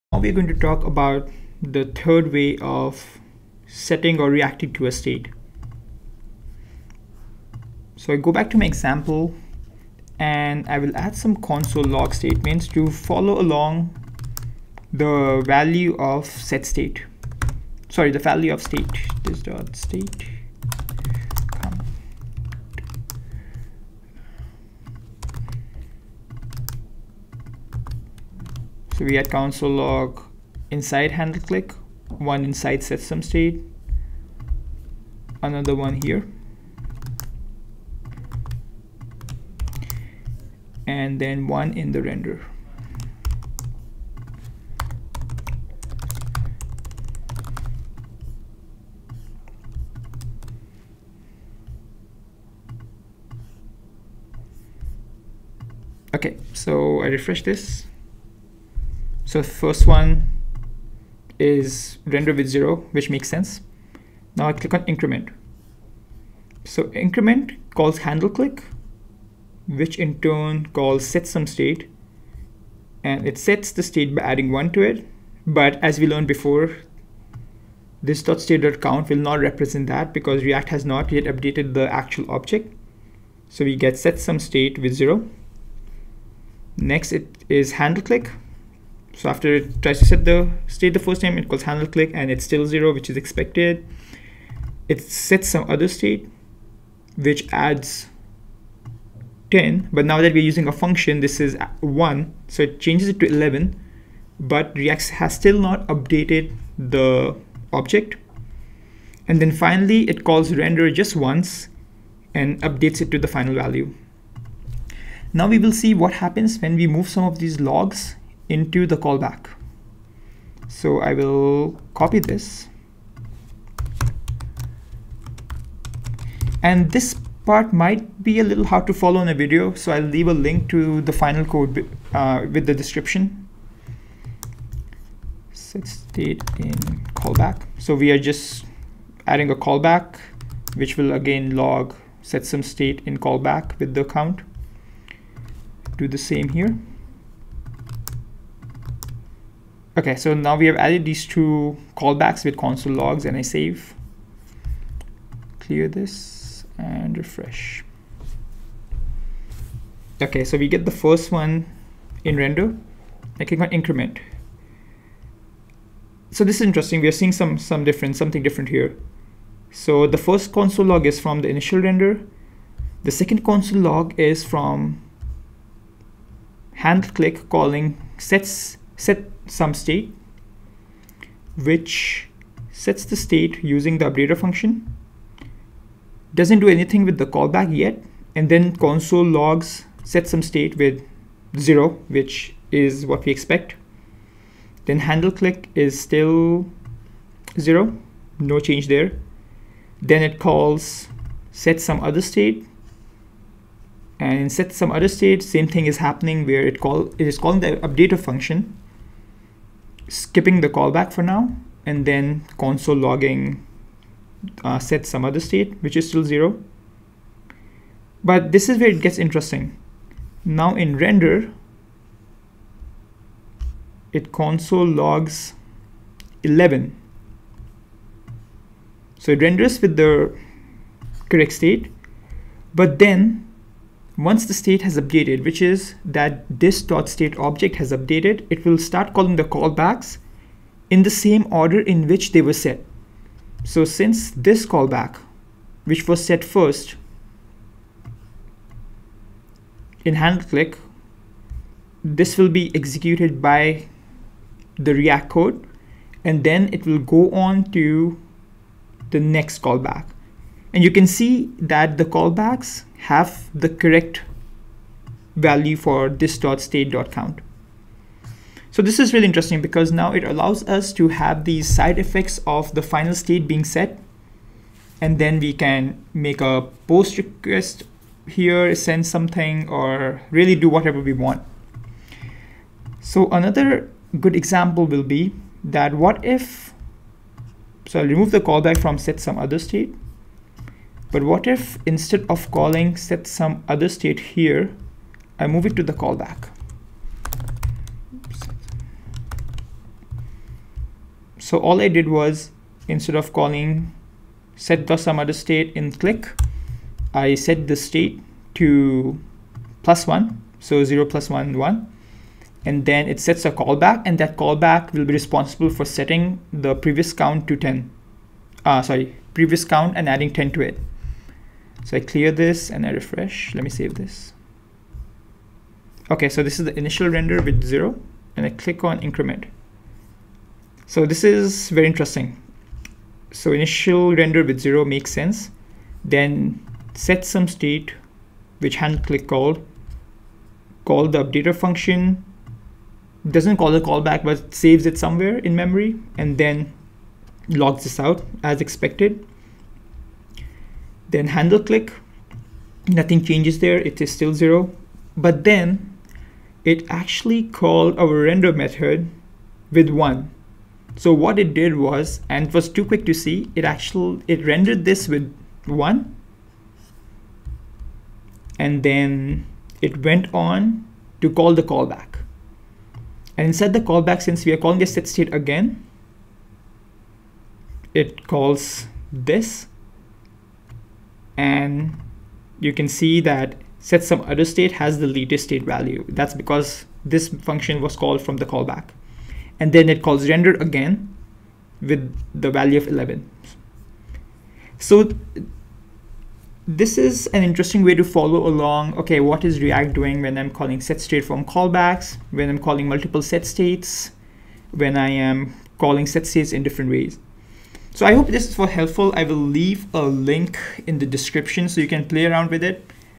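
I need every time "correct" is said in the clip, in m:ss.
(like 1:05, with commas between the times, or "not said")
3:51, 4:23.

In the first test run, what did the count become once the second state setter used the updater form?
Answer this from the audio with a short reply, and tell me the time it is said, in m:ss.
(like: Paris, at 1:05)
11, at 1:42.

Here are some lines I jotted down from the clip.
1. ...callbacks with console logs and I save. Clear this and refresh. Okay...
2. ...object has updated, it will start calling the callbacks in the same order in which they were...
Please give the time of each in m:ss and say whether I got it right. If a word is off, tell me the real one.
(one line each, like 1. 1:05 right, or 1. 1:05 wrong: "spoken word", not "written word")
1. 2:31 right
2. 3:57 right.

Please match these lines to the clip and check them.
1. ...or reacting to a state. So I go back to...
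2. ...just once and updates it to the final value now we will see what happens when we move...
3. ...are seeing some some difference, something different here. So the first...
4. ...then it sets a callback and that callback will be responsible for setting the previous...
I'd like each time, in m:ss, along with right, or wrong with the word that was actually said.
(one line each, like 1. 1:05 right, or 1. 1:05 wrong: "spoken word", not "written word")
1. 0:04 right
2. 1:50 right
3. 2:47 right
4. 5:12 right.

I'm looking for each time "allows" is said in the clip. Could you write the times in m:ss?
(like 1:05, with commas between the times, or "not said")
4:30.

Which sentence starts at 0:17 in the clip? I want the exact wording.
Sorry, the value of state, this dot state.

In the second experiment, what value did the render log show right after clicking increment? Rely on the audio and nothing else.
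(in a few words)
11.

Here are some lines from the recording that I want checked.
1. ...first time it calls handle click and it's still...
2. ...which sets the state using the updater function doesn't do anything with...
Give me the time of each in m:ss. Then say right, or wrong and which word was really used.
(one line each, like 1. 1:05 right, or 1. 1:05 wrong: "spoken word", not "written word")
1. 1:30 right
2. 3:01 right.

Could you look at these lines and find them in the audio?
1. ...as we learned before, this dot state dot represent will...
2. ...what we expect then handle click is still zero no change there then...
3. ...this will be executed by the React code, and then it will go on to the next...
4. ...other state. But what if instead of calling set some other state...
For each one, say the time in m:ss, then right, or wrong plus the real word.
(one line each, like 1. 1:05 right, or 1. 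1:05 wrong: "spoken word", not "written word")
1. 1:15 wrong: "count", not "represent"
2. 3:13 right
3. 4:12 right
4. 4:49 right.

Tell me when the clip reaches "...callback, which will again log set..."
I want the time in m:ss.
2:19.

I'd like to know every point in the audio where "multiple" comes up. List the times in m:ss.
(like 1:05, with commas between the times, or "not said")
6:42.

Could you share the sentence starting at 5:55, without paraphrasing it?
But then it actually called our render method with one.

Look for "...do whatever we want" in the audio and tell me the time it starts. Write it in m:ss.
4:40.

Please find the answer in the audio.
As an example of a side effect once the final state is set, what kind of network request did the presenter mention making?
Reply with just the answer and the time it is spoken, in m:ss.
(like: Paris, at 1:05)
post request, at 4:36.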